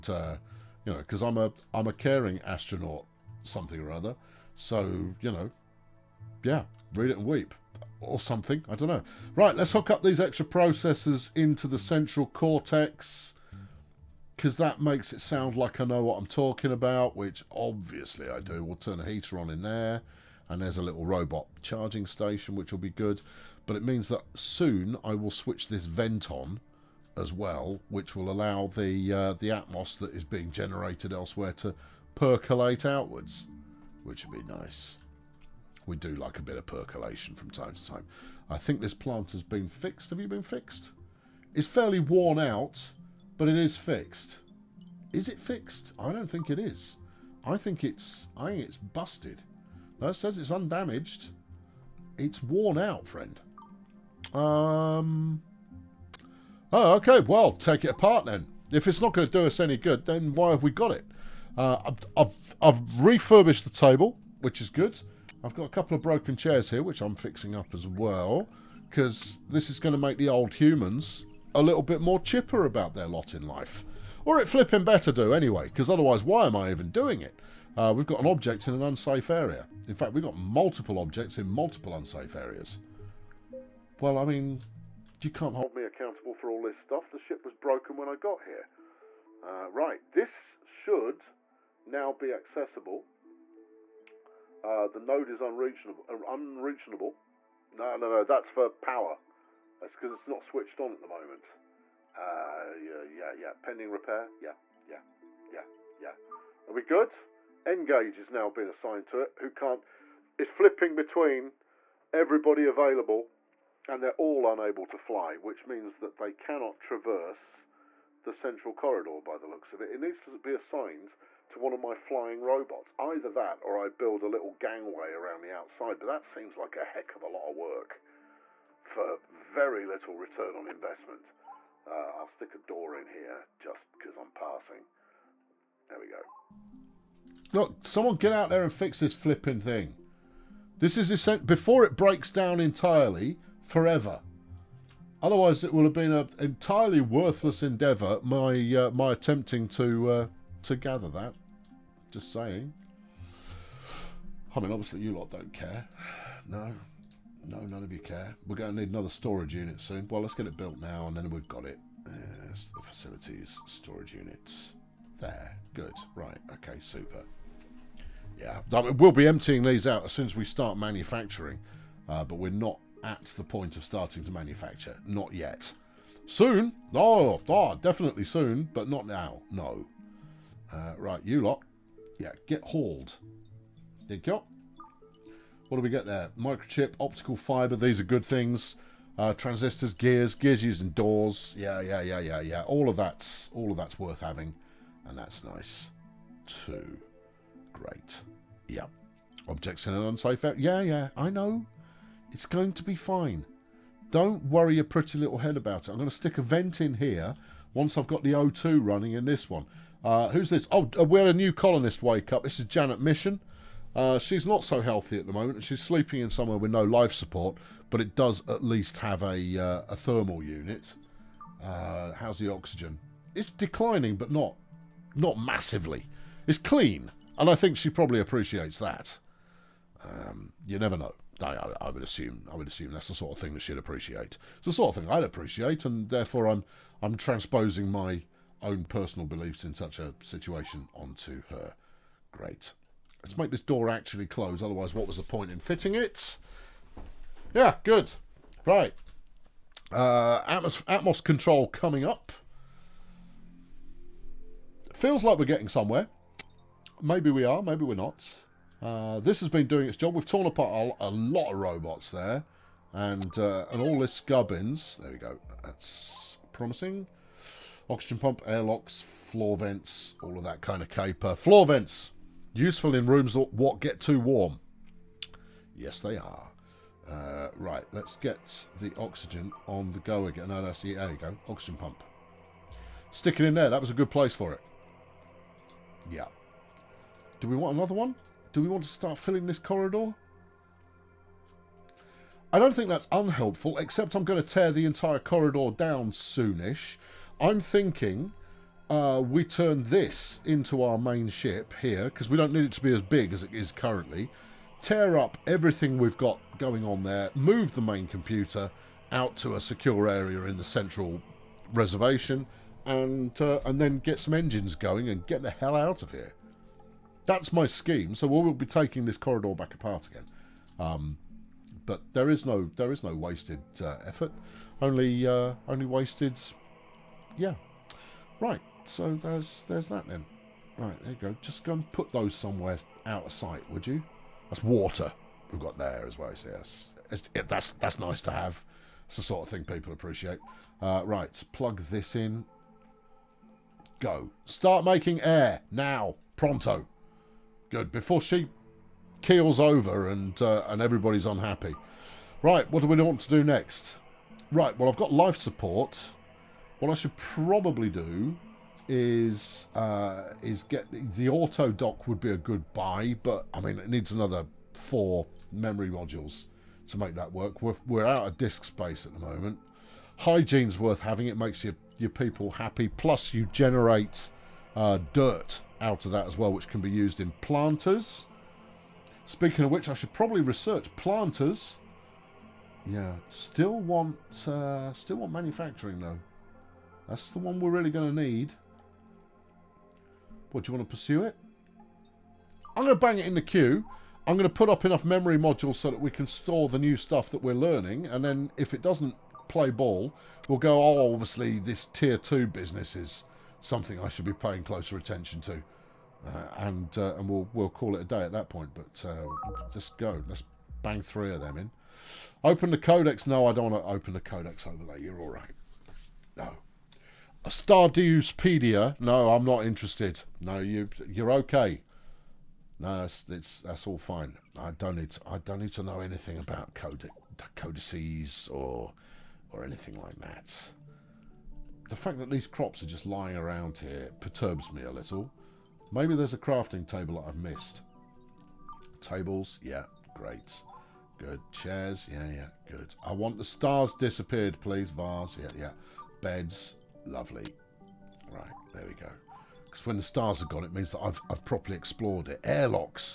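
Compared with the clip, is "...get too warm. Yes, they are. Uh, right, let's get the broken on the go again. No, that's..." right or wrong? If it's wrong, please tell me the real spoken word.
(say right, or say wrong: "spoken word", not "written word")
wrong: "oxygen", not "broken".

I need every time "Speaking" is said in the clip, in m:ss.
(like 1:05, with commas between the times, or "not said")
6:19.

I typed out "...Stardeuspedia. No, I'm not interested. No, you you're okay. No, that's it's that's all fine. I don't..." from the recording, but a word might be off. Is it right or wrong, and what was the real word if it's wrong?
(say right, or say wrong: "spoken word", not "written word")
right.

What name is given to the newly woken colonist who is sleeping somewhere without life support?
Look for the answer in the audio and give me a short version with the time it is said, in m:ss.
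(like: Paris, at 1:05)
Janet Mission, at 3:32.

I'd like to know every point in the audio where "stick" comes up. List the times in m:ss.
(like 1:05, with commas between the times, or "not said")
2:12, 3:26, 4:43.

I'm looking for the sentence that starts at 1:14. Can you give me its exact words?
Or it flipping better do anyway, because otherwise why am I even doing it?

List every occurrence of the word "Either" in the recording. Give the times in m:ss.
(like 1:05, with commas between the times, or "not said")
2:02.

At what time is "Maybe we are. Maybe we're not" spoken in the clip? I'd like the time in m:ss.
4:17.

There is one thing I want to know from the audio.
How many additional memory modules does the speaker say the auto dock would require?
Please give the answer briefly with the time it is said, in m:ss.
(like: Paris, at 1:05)
4, at 6:04.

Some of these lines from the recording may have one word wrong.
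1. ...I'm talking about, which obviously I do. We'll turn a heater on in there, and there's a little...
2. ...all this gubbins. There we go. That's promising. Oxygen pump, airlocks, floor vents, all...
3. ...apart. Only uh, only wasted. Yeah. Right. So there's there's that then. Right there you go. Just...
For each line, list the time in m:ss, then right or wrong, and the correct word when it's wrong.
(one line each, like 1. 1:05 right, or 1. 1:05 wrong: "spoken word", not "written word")
1. 0:16 right
2. 4:23 right
3. 5:24 wrong: "effort", not "apart".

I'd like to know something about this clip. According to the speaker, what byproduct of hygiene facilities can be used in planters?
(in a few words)
Dirt.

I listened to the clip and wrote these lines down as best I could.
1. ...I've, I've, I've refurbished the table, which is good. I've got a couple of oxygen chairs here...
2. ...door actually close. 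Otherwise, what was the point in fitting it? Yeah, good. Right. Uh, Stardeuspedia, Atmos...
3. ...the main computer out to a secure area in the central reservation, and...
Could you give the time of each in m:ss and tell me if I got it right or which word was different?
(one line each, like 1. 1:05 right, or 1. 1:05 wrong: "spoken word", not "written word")
1. 1:01 wrong: "broken", not "oxygen"
2. 4:03 wrong: "Atmos", not "Stardeuspedia"
3. 5:07 right.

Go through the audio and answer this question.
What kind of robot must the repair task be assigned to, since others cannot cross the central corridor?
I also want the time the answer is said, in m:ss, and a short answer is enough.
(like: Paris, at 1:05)
Flying robots, at 2:01.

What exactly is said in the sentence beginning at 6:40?
Oh, obviously this tier two business is something I should be paying closer attention to.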